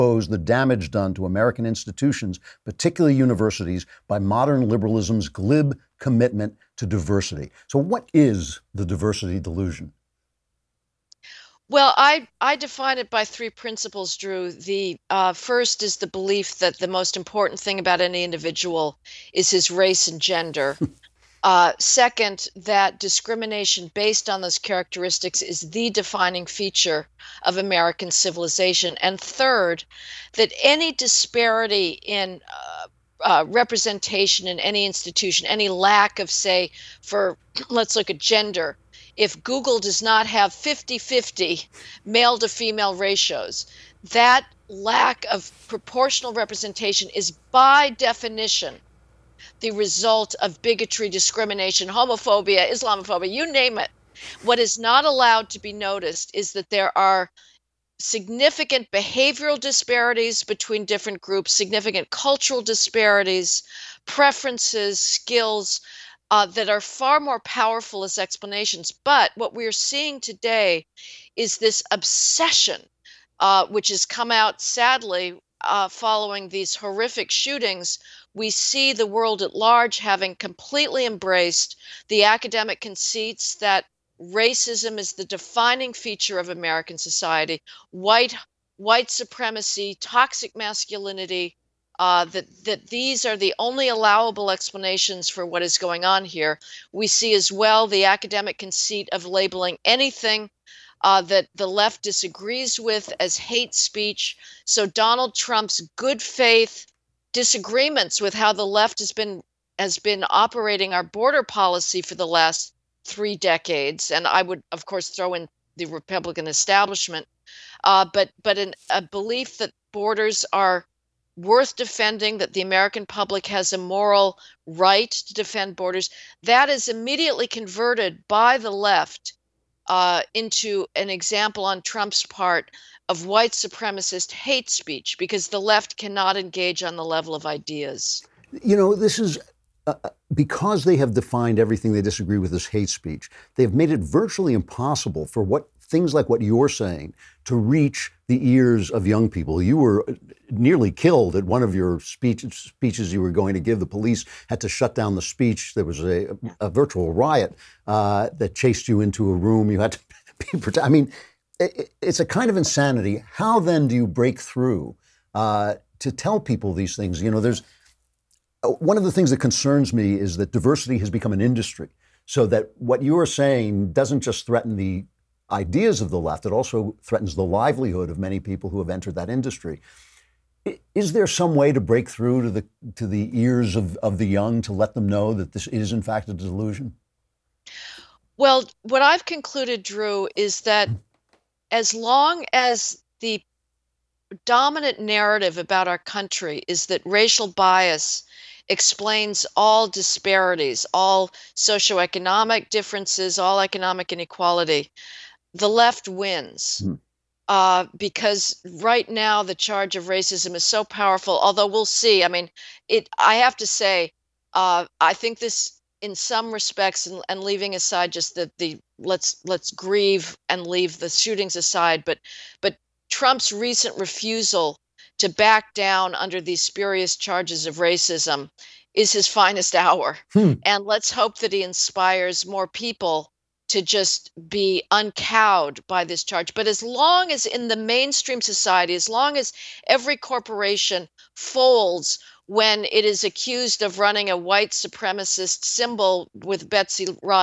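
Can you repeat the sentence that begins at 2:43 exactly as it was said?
How then do you break through uh, to tell people these things?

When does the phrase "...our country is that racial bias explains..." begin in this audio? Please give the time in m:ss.
3:15.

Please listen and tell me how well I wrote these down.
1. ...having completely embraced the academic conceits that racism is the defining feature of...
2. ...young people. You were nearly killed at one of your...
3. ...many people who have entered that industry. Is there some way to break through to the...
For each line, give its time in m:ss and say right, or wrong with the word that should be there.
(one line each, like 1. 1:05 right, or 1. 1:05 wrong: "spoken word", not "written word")
1. 1:19 right
2. 2:29 right
3. 2:58 right.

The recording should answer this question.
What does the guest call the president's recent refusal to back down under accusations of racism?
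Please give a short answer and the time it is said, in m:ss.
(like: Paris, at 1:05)
his finest hour, at 3:49.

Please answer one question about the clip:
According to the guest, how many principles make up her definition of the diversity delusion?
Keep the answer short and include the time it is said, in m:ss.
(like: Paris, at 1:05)
3, at 0:13.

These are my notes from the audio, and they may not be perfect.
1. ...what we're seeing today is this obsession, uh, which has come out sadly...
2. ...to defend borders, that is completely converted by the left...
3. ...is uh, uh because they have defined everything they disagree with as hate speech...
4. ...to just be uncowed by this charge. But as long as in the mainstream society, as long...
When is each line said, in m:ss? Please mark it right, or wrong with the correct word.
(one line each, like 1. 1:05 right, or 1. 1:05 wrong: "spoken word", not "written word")
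1. 1:09 right
2. 2:05 wrong: "immediately", not "completely"
3. 2:19 right
4. 3:53 right.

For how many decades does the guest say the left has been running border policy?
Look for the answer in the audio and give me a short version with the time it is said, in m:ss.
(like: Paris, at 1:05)
3, at 1:53.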